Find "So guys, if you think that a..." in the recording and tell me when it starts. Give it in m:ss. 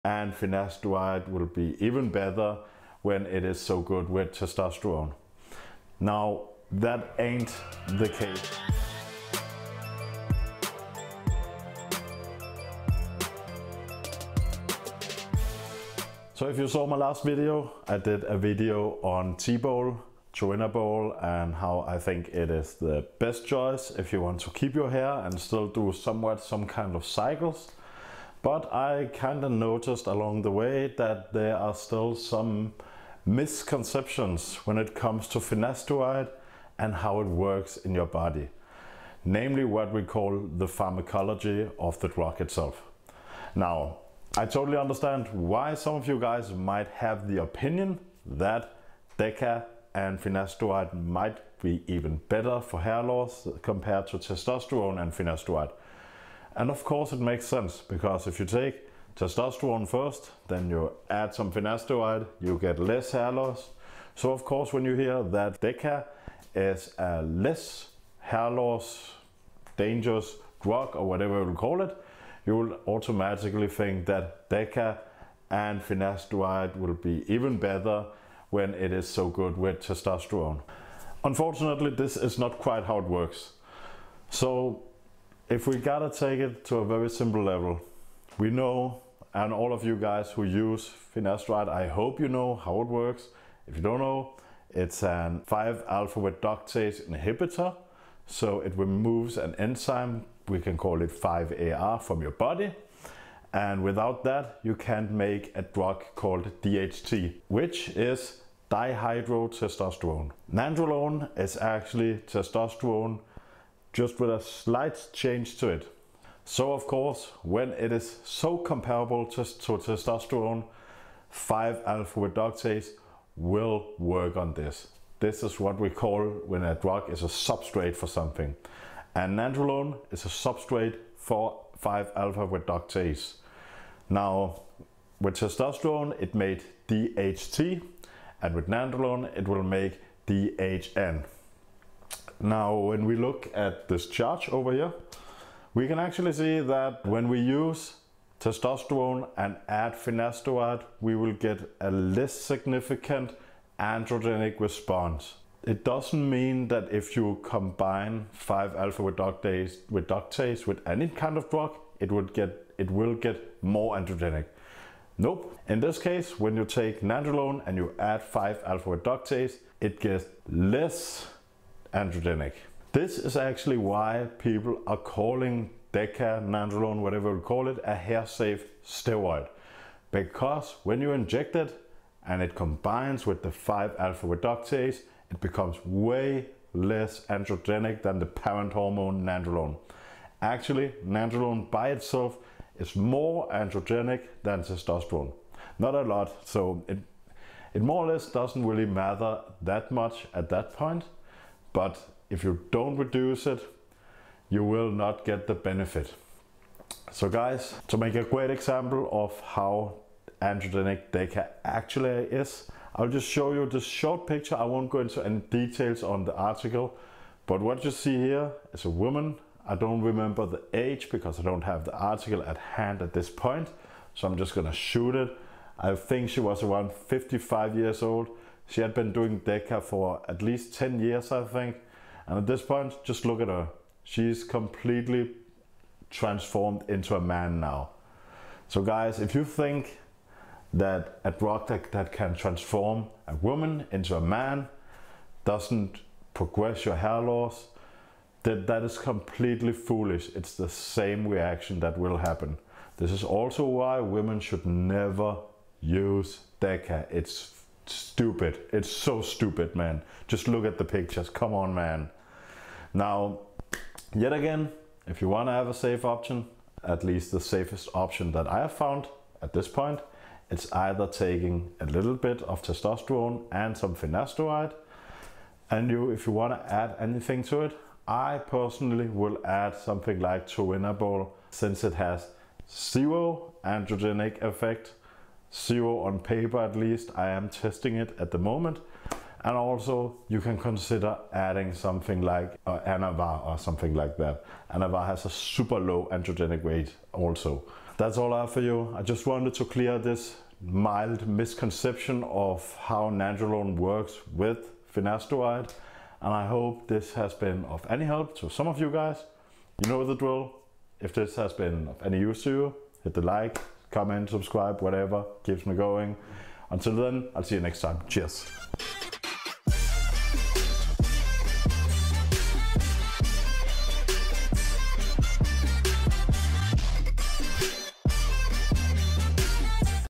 3:58.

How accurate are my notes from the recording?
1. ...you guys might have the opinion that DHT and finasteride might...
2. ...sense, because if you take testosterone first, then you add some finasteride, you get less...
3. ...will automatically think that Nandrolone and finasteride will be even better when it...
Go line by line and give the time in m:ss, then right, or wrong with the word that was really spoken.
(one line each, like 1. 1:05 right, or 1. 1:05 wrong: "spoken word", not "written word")
1. 0:46 wrong: "DECA", not "DHT"
2. 0:57 right
3. 1:12 wrong: "DECA", not "Nandrolone".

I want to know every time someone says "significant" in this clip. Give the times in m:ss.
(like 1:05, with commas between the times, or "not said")
2:32.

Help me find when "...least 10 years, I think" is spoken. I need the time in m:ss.
3:50.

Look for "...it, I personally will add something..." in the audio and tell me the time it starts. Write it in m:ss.
4:37.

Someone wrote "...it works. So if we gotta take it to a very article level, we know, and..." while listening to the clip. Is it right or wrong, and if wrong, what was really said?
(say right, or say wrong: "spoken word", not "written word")
wrong: "simple", not "article".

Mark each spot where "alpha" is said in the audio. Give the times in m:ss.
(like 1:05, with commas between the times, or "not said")
1:35, 2:01, 2:11, 2:38, 2:48, 3:03.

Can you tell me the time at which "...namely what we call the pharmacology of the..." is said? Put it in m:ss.
0:39.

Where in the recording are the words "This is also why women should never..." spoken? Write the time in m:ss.
4:12.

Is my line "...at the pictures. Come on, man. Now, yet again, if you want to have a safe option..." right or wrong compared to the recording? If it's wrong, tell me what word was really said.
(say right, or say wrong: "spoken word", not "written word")
right.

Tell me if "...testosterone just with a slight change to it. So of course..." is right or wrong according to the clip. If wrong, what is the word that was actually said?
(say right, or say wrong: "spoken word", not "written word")
right.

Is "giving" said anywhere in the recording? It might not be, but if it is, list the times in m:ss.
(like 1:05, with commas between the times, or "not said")
not said.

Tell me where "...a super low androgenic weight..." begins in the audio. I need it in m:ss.
4:55.